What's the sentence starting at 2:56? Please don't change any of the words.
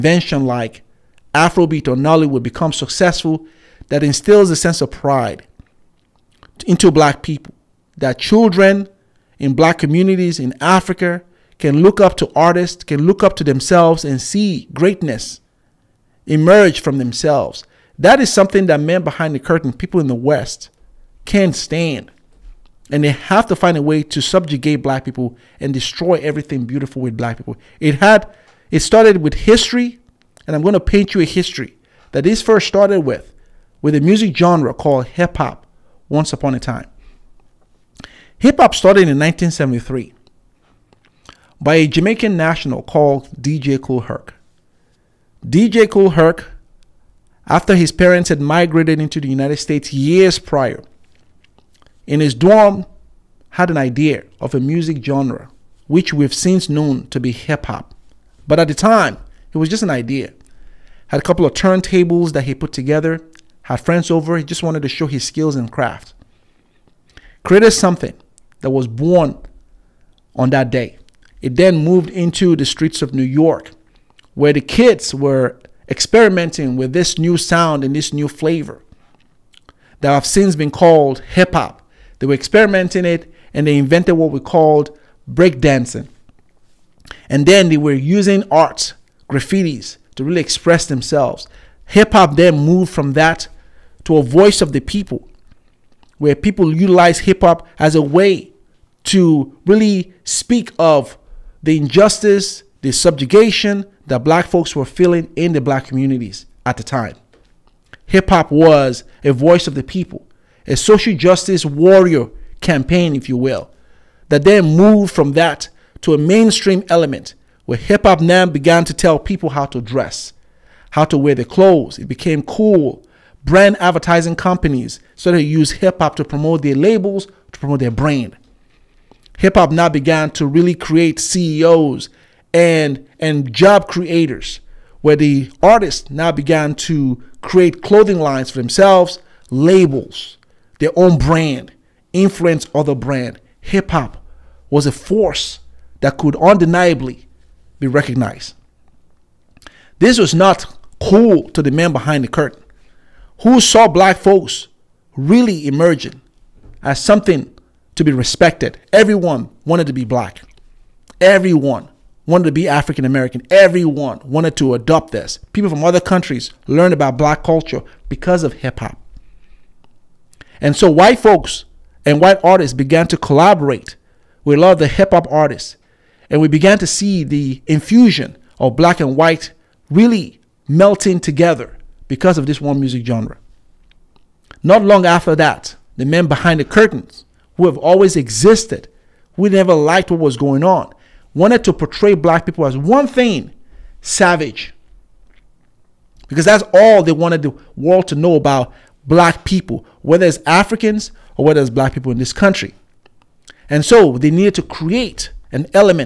And we began to see the infusion of black and white really melting together because of this one music genre.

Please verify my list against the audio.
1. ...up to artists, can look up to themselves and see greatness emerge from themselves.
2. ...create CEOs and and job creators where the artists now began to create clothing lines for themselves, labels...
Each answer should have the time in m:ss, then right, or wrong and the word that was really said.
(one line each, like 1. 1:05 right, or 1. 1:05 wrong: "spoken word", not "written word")
1. 0:12 right
2. 2:10 right.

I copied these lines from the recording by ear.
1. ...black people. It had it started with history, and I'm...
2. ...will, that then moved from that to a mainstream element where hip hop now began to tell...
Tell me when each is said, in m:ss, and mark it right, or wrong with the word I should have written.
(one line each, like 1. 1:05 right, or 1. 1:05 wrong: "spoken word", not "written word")
1. 0:27 right
2. 1:53 right.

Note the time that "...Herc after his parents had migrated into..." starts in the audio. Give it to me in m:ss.
0:46.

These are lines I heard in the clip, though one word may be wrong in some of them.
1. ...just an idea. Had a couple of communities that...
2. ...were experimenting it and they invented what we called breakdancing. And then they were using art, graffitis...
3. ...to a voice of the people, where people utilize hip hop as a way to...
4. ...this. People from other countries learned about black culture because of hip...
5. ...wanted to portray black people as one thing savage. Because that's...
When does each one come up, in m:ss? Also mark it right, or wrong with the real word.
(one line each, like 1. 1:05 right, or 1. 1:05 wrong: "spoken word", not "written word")
1. 0:59 wrong: "turntables", not "communities"
2. 1:22 right
3. 1:34 right
4. 2:45 right
5. 3:11 right.